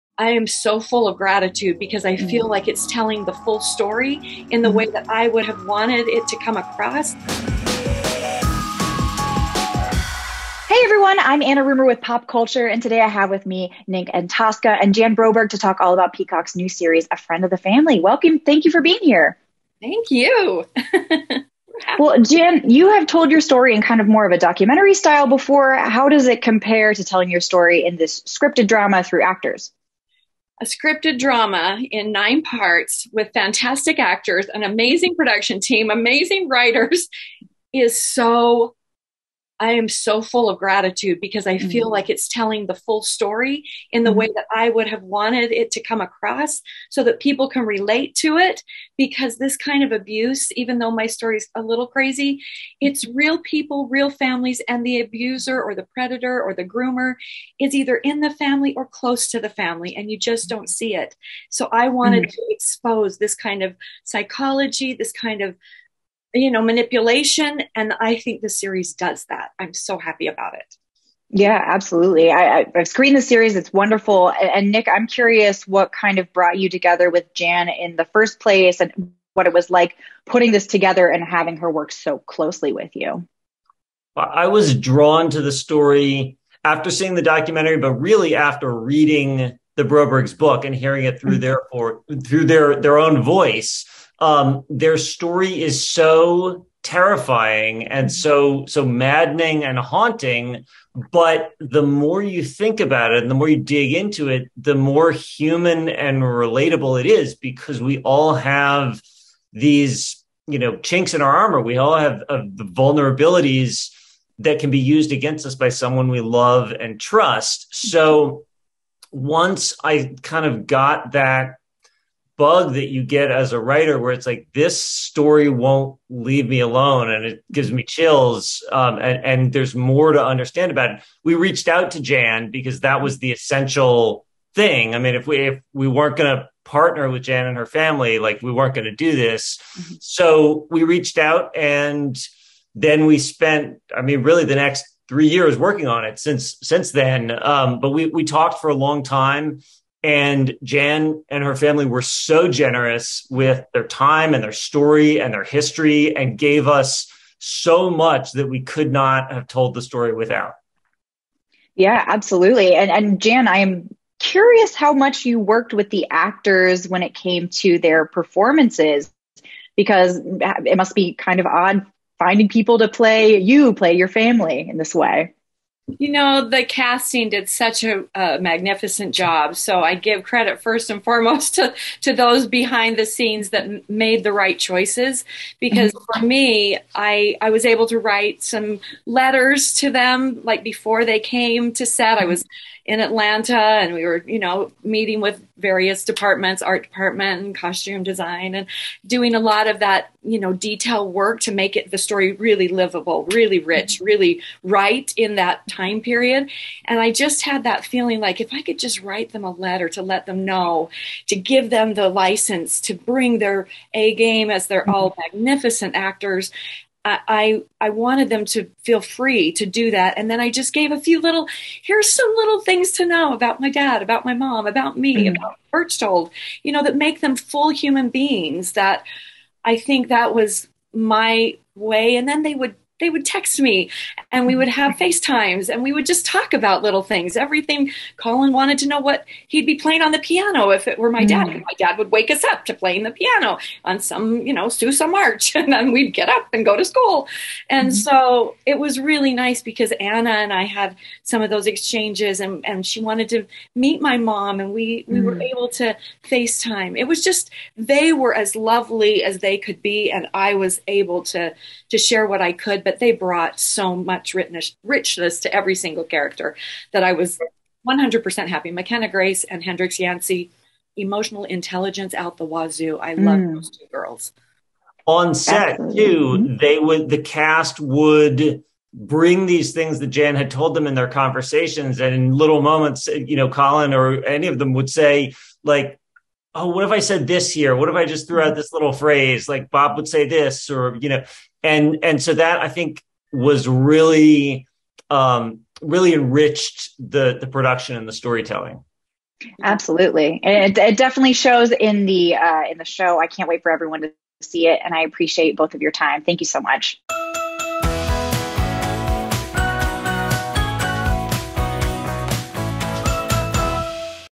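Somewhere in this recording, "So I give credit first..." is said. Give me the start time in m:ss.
2:59.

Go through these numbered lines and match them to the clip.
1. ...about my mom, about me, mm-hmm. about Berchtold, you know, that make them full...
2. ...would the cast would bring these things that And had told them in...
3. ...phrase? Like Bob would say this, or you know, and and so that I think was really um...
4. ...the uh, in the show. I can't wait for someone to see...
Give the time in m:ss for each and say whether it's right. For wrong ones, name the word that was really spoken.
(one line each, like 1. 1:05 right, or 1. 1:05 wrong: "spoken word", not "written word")
1. 3:44 right
2. 4:36 wrong: "Jan", not "And"
3. 4:48 right
4. 5:02 wrong: "everyone", not "someone".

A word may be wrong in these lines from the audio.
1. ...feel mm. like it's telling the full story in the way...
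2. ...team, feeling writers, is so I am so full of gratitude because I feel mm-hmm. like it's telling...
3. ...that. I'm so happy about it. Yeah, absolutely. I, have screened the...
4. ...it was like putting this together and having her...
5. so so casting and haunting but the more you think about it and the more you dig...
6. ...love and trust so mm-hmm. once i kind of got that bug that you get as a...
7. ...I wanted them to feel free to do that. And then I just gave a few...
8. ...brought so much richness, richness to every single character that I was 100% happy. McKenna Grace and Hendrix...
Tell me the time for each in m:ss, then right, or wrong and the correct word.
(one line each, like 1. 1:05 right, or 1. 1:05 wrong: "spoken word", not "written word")
1. 0:02 right
2. 0:35 wrong: "amazing", not "feeling"
3. 1:09 right
4. 1:19 right
5. 1:38 wrong: "maddening", not "casting"
6. 1:56 right
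7. 3:37 right
8. 4:23 right.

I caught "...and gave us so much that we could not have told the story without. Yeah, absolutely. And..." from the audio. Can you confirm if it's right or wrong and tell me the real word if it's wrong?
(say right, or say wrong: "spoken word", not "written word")
right.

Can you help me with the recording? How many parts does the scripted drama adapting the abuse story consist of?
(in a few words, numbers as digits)
9.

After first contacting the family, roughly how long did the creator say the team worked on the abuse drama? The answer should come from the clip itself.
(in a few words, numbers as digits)
3 years.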